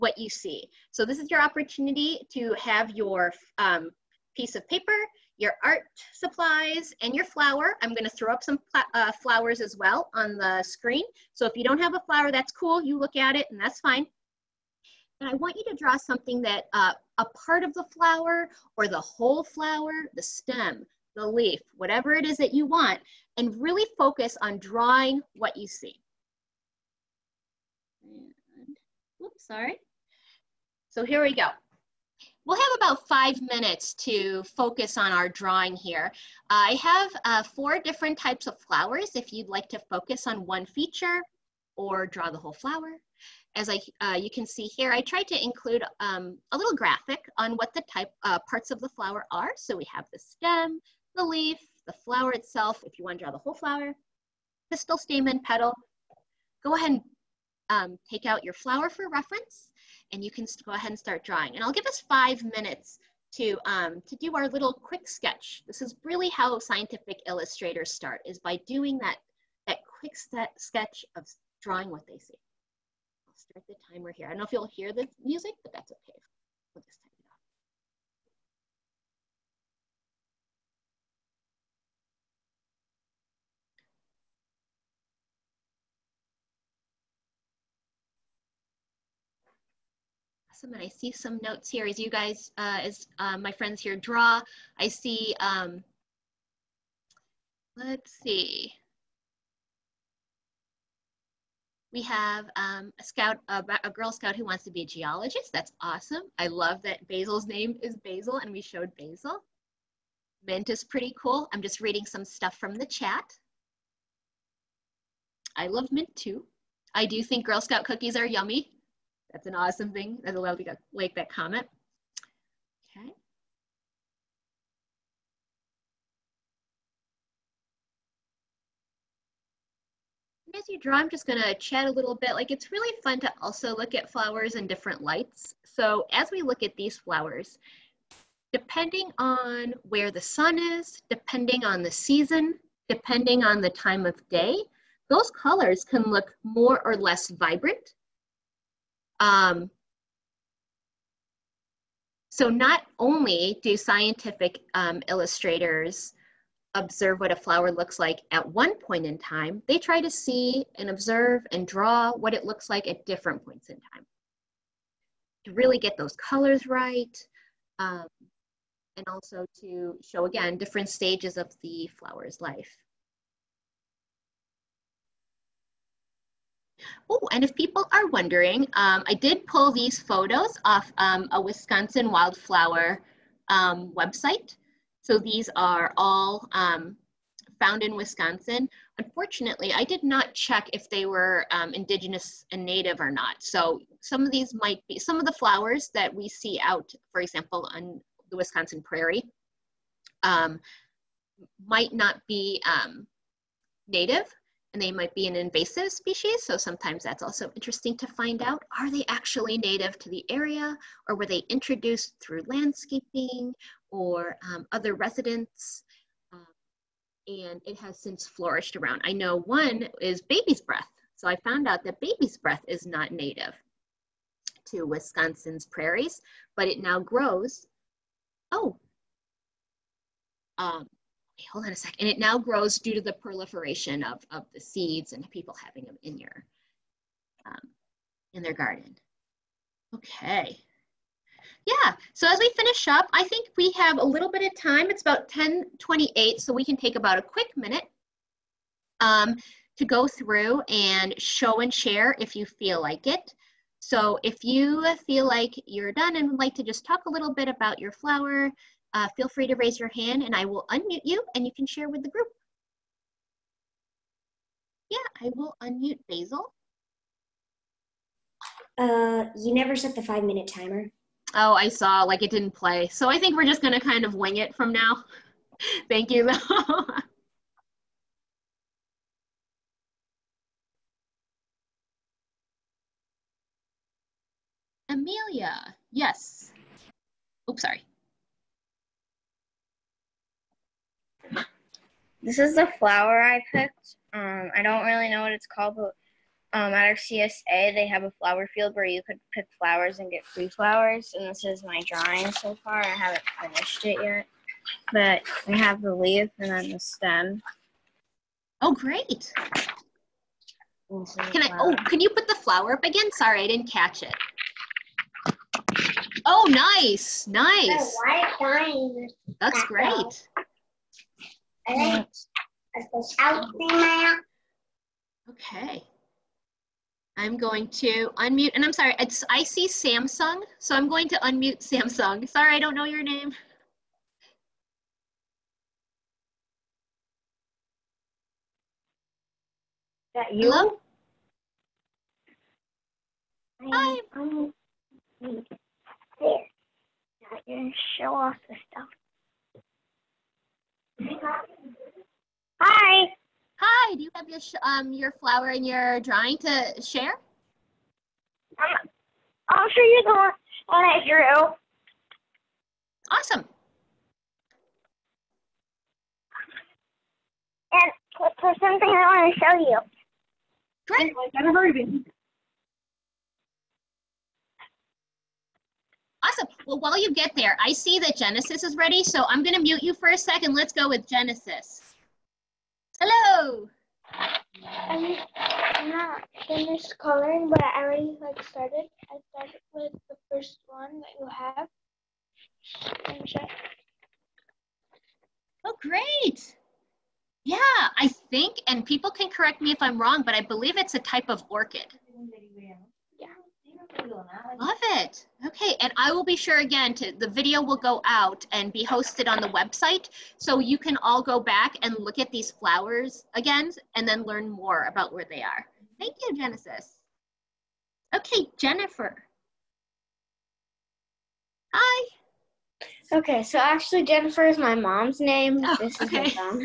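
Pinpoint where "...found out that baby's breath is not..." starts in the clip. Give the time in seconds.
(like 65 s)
221 s.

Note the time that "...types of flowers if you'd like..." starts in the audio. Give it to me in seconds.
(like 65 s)
38 s.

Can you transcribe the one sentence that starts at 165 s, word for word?
To really get those colors right, um, and also to show again different stages of the flower's life.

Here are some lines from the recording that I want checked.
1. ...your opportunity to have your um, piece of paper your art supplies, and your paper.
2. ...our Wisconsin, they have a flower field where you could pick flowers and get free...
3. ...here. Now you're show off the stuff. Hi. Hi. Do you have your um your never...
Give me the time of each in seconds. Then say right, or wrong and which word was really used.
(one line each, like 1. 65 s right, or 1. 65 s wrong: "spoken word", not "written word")
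1. 1 s wrong: "flower", not "paper"
2. 296 s wrong: "CSA", not "Wisconsin"
3. 345 s wrong: "flower", not "never".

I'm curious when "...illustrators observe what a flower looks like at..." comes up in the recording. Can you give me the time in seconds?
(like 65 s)
155 s.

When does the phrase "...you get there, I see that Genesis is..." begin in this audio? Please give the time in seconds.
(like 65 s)
376 s.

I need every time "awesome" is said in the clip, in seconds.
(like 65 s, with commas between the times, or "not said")
90 s, 105 s, 119 s, 363 s.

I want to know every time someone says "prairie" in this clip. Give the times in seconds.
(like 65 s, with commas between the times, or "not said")
198 s, 225 s.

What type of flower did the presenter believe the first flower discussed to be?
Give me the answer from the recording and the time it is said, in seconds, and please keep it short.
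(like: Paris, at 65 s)
Orchid, at 401 s.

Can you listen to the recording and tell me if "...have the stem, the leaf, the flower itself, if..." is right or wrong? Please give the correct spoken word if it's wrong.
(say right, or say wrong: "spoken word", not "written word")
right.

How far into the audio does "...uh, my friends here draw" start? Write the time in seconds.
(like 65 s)
93 s.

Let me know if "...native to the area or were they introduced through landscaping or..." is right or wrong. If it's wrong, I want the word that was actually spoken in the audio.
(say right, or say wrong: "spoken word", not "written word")
right.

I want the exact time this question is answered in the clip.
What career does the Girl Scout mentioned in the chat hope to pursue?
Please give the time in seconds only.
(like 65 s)
104 s.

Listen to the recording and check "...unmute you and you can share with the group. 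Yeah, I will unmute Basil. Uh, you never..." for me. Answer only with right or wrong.
right.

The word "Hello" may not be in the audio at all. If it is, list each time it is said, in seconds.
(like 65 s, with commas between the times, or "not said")
340 s, 382 s.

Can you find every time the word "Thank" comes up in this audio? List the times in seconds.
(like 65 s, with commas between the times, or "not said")
275 s, 415 s.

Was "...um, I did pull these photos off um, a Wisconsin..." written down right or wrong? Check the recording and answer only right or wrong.
right.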